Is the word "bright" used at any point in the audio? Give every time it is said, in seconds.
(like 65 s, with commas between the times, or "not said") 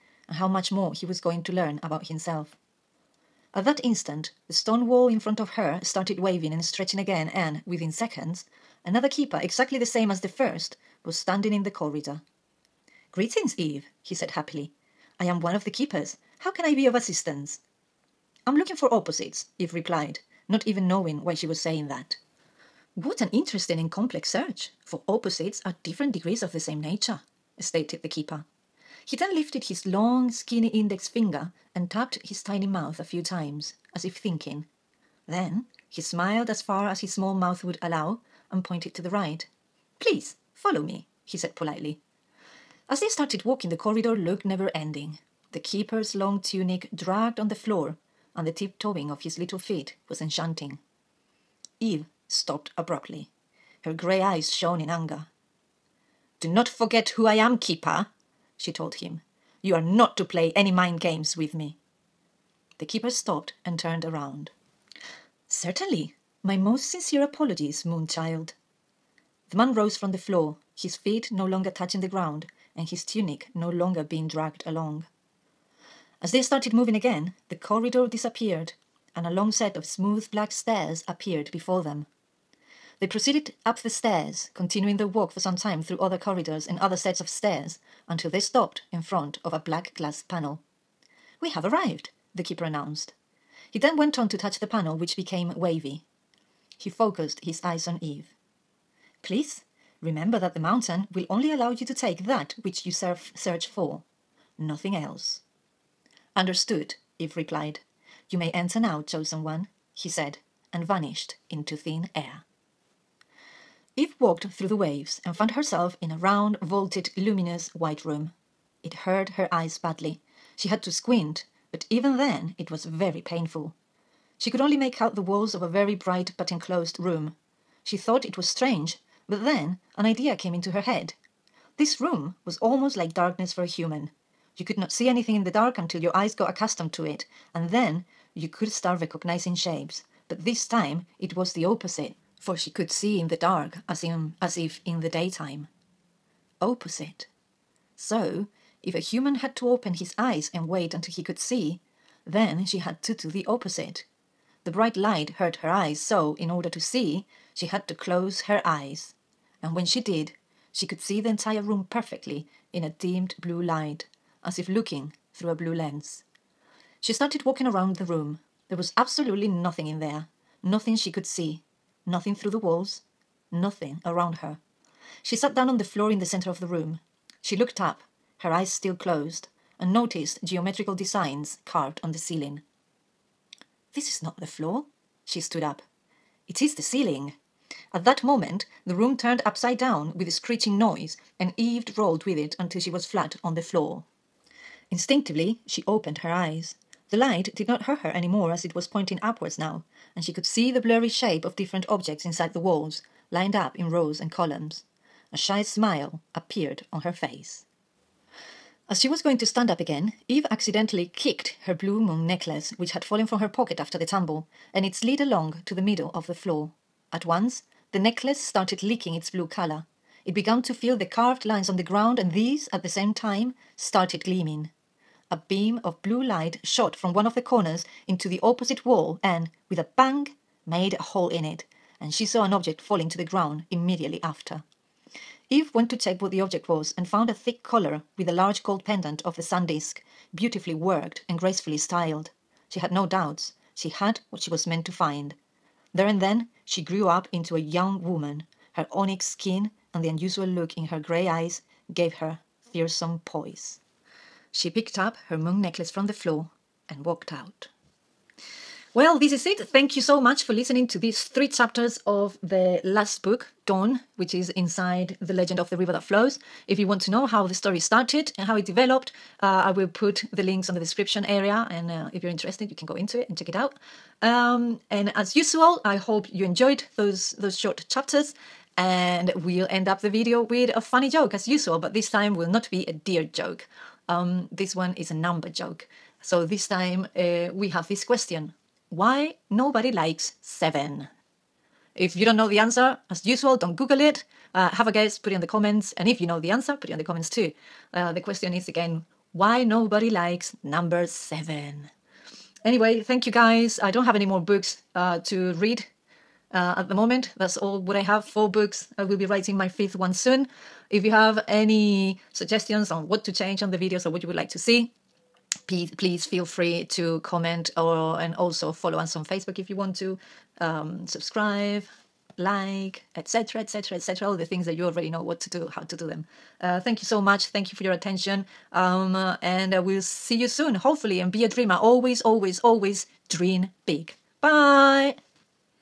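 125 s, 154 s.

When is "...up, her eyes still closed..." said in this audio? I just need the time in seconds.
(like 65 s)
177 s.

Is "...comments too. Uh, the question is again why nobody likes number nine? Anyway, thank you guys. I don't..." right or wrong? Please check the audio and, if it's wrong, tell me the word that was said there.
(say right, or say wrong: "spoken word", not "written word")
wrong: "seven", not "nine".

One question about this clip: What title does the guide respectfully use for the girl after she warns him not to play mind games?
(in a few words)
Moonchild.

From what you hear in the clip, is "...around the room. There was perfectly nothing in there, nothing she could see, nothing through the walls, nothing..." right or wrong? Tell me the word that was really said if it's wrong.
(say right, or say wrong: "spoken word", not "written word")
wrong: "absolutely", not "perfectly".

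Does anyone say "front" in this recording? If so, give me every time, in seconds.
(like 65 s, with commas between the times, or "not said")
5 s, 89 s.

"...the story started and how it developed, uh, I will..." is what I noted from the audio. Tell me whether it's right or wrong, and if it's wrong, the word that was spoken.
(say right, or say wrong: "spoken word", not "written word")
right.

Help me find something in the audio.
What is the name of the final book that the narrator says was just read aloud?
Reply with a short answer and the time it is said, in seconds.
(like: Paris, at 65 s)
Dawn, at 263 s.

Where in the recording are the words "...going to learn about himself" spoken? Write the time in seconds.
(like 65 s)
1 s.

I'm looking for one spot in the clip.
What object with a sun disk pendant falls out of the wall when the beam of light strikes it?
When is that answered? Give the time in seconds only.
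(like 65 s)
237 s.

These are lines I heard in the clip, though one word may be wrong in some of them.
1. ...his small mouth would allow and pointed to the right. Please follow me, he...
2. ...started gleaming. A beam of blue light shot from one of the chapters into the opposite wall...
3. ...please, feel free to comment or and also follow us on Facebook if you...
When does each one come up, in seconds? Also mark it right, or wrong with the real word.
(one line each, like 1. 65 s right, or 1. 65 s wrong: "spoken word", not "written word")
1. 36 s right
2. 223 s wrong: "corners", not "chapters"
3. 315 s right.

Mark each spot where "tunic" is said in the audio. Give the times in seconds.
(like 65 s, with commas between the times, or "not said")
46 s, 73 s.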